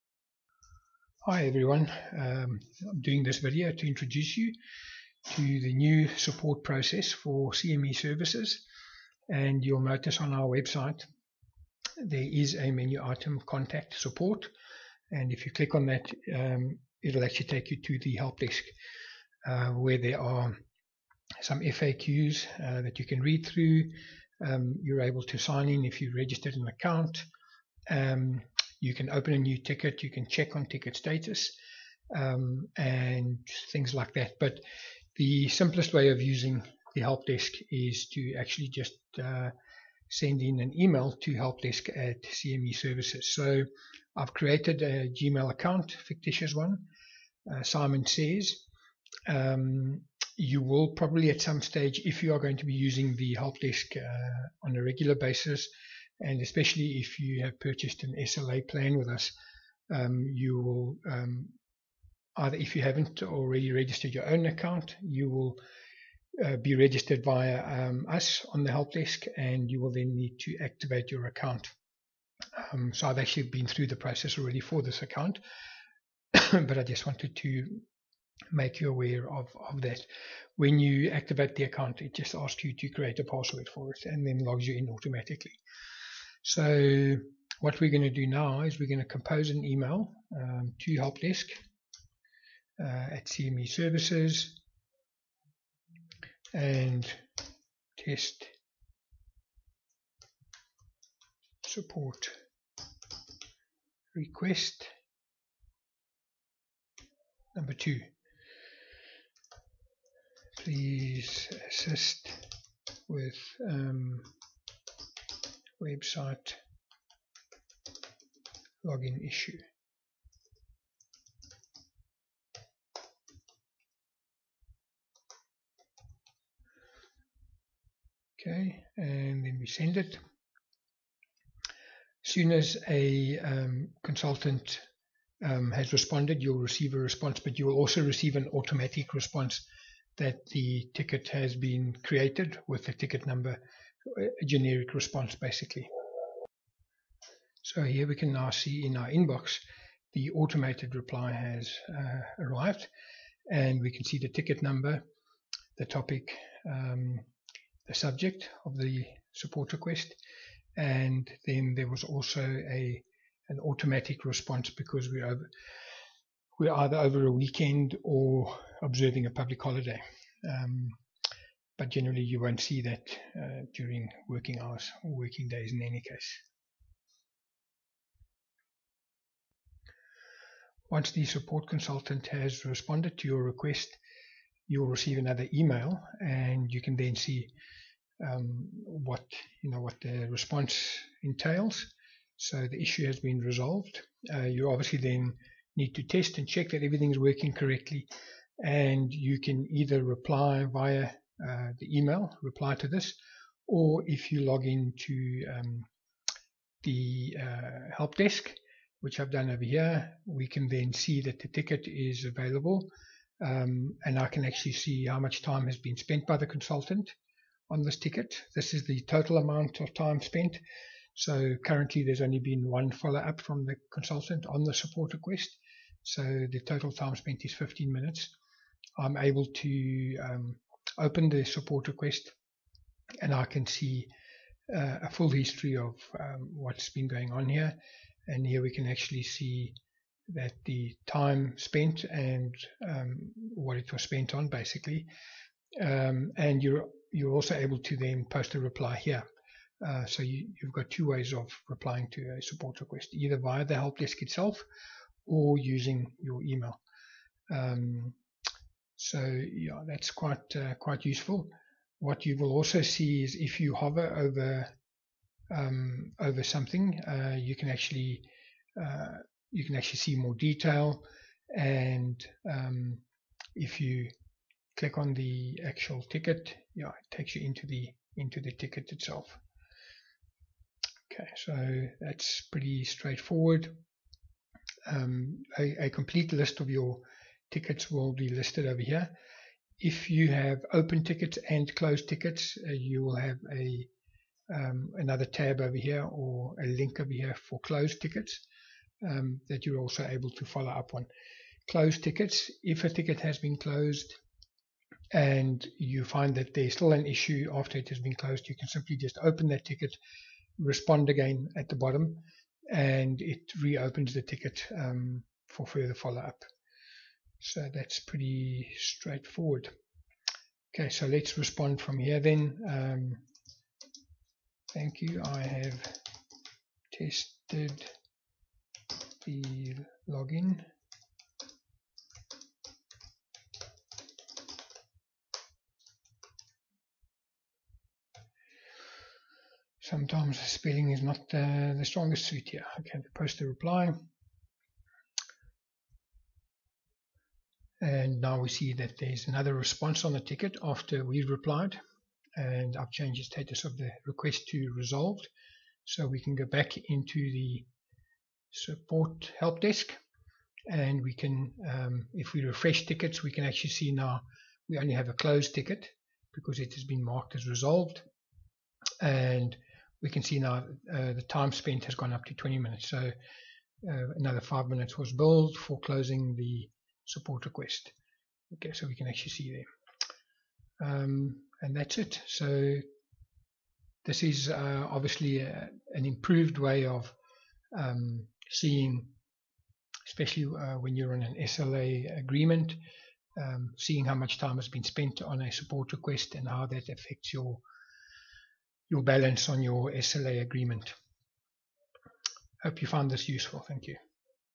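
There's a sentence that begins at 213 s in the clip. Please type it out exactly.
Um, and I can actually see how much time has been spent by the consultant on this ticket.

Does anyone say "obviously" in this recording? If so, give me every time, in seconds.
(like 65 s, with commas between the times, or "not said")
194 s, 384 s.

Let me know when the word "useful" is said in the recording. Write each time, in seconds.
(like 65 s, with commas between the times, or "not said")
261 s, 403 s.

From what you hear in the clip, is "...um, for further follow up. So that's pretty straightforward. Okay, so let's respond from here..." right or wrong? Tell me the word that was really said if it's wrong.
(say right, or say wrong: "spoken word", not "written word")
right.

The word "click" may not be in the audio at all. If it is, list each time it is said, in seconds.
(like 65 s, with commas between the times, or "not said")
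15 s, 274 s.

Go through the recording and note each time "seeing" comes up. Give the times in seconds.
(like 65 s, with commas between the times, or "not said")
388 s, 393 s.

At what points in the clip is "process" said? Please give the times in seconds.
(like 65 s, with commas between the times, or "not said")
6 s, 73 s.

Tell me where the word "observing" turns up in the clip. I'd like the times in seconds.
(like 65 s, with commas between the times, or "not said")
168 s.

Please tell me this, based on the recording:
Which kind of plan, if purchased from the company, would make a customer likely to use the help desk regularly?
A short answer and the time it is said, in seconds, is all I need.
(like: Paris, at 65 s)
SLA plan, at 58 s.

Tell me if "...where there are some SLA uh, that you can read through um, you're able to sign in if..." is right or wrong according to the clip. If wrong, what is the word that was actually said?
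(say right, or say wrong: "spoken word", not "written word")
wrong: "FAQs", not "SLA".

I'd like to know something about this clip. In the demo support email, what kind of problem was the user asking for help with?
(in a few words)
website login issue.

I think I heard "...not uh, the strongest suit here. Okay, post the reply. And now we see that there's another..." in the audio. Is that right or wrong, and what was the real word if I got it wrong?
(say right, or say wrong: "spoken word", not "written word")
right.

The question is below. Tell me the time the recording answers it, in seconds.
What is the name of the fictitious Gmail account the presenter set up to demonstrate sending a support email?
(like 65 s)
47 s.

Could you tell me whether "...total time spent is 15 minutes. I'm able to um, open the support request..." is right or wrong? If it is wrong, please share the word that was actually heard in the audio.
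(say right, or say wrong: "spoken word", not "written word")
right.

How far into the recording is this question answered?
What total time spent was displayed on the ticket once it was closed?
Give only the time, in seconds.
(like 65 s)
372 s.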